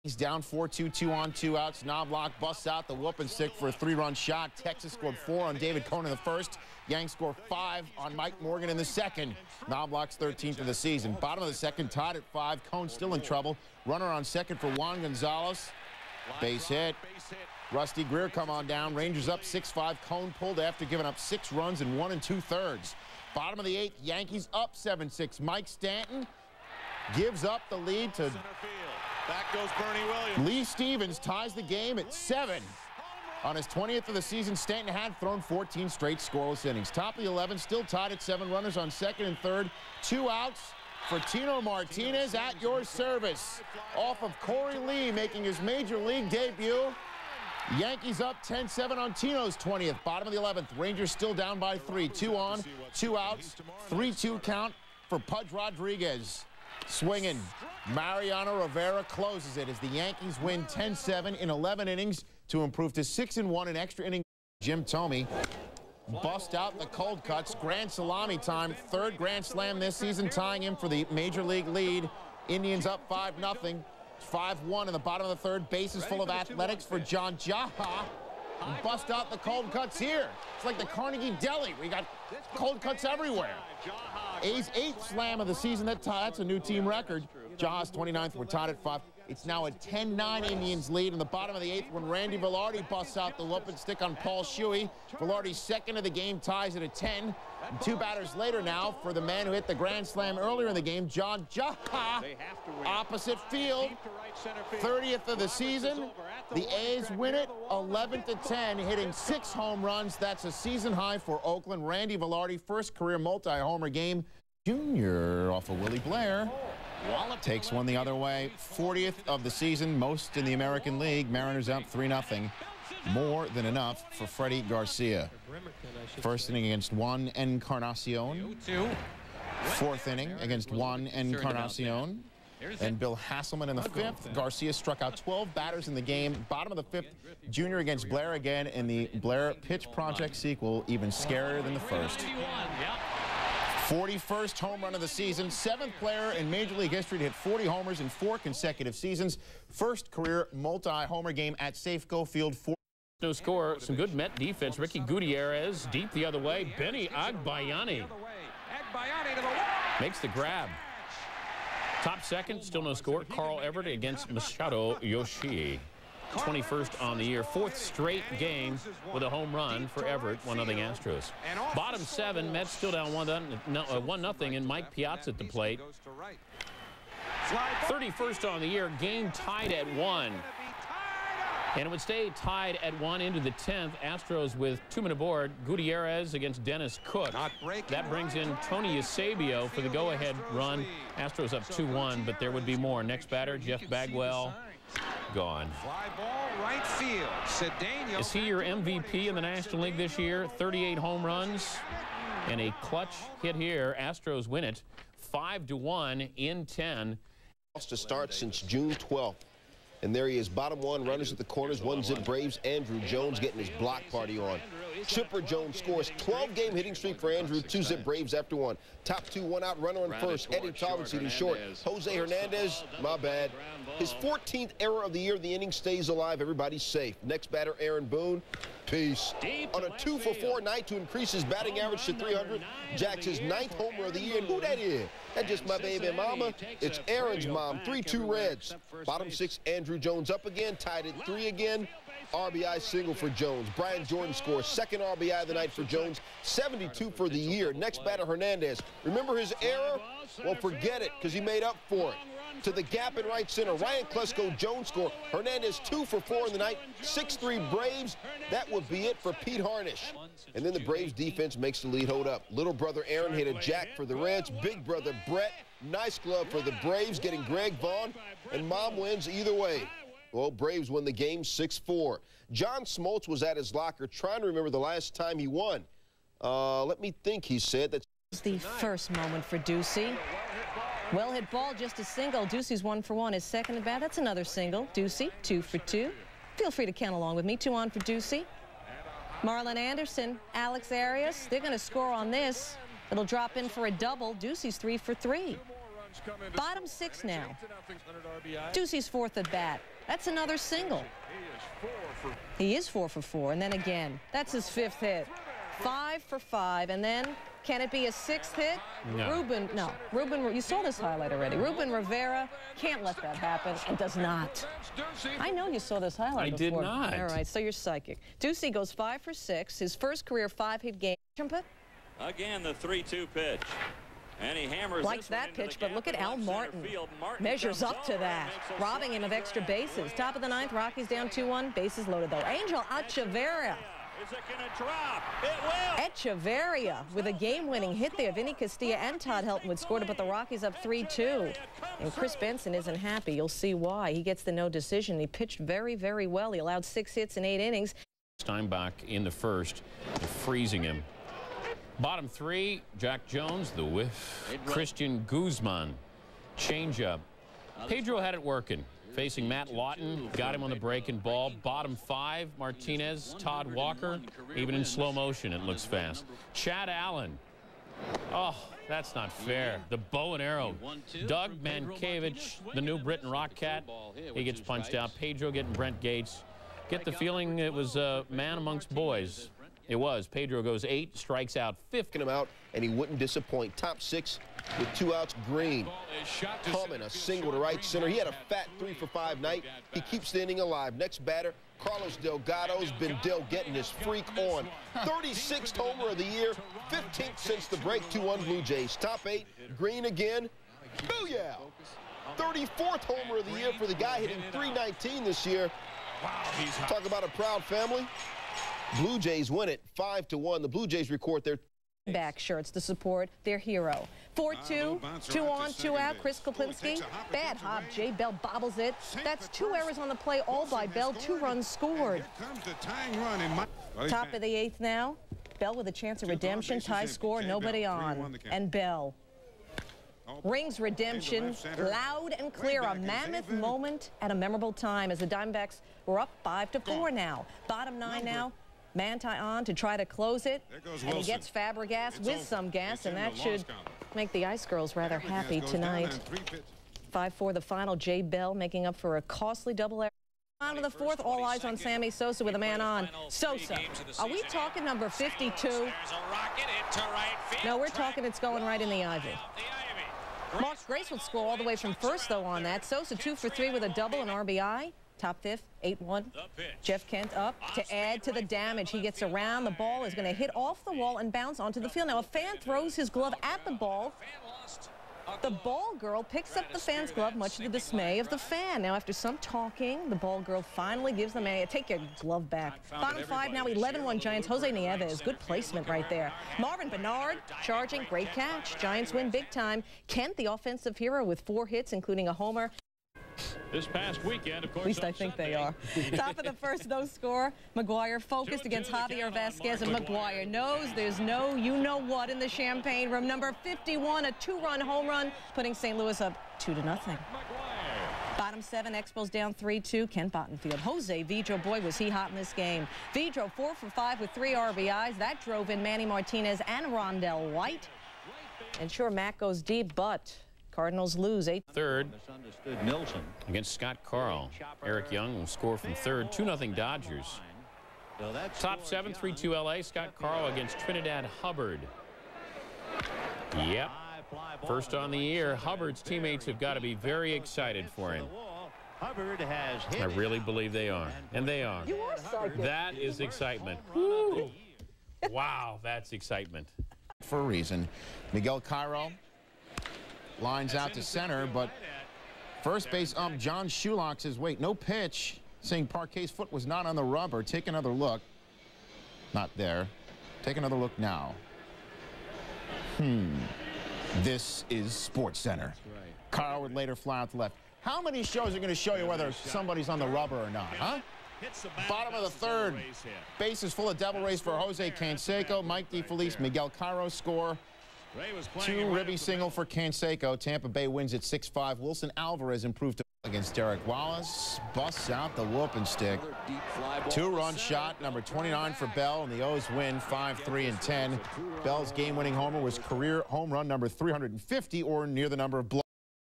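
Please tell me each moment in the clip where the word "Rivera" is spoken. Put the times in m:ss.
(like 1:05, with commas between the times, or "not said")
0:58, 5:11.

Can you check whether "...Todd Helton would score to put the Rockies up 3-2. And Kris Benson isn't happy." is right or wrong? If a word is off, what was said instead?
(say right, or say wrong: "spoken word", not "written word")
right.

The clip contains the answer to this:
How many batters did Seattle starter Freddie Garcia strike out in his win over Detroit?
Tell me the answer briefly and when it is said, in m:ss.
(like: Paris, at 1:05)
12, at 2:15.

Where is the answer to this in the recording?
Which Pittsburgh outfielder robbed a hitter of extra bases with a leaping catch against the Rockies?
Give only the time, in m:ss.
5:26.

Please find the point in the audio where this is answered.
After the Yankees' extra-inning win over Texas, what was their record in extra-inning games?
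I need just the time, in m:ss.
1:03.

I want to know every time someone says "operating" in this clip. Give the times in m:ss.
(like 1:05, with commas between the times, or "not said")
not said.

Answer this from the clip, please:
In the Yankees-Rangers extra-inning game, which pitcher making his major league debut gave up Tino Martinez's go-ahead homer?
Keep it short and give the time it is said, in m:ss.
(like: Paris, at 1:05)
Corey Lee, at 0:44.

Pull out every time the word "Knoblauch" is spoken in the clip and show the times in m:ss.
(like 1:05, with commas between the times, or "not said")
0:01, 0:09.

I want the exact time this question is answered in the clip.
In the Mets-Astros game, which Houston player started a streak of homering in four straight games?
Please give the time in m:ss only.
2:43.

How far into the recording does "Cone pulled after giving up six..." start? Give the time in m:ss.
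0:20.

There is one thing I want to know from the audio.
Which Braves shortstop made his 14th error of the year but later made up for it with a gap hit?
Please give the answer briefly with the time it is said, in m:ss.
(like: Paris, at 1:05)
Jose Hernandez, at 3:41.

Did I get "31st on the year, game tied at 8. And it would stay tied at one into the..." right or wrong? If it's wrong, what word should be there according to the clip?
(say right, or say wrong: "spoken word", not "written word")
wrong: "1", not "8".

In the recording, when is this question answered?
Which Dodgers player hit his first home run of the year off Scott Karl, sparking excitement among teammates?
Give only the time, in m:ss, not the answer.
8:50.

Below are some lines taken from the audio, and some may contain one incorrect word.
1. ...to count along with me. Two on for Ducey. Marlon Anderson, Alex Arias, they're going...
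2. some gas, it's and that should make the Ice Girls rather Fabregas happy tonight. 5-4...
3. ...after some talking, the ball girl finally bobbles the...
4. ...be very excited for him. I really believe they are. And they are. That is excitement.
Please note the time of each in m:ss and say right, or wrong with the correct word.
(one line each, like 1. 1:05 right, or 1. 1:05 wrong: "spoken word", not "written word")
1. 4:46 right
2. 7:22 right
3. 7:58 wrong: "gives", not "bobbles"
4. 8:56 right.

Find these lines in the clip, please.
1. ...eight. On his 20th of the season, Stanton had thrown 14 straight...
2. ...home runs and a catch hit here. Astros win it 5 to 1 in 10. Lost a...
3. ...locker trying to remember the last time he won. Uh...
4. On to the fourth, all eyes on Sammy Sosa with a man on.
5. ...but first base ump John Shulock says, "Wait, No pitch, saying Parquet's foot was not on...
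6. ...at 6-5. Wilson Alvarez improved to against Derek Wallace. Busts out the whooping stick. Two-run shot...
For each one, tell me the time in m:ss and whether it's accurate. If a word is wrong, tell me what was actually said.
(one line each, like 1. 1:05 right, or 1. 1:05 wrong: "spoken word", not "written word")
1. 0:32 wrong: "seven", not "eight"
2. 3:20 wrong: "clutch", not "catch"
3. 4:33 right
4. 7:30 right
5. 9:11 right
6. 9:41 right.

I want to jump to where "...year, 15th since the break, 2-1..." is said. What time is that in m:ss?
6:36.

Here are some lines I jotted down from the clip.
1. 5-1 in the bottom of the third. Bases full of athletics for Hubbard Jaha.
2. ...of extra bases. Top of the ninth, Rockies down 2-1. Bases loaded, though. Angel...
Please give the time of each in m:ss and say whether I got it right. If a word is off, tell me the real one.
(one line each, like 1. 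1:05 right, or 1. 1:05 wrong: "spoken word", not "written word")
1. 1:14 wrong: "John", not "Hubbard"
2. 5:29 right.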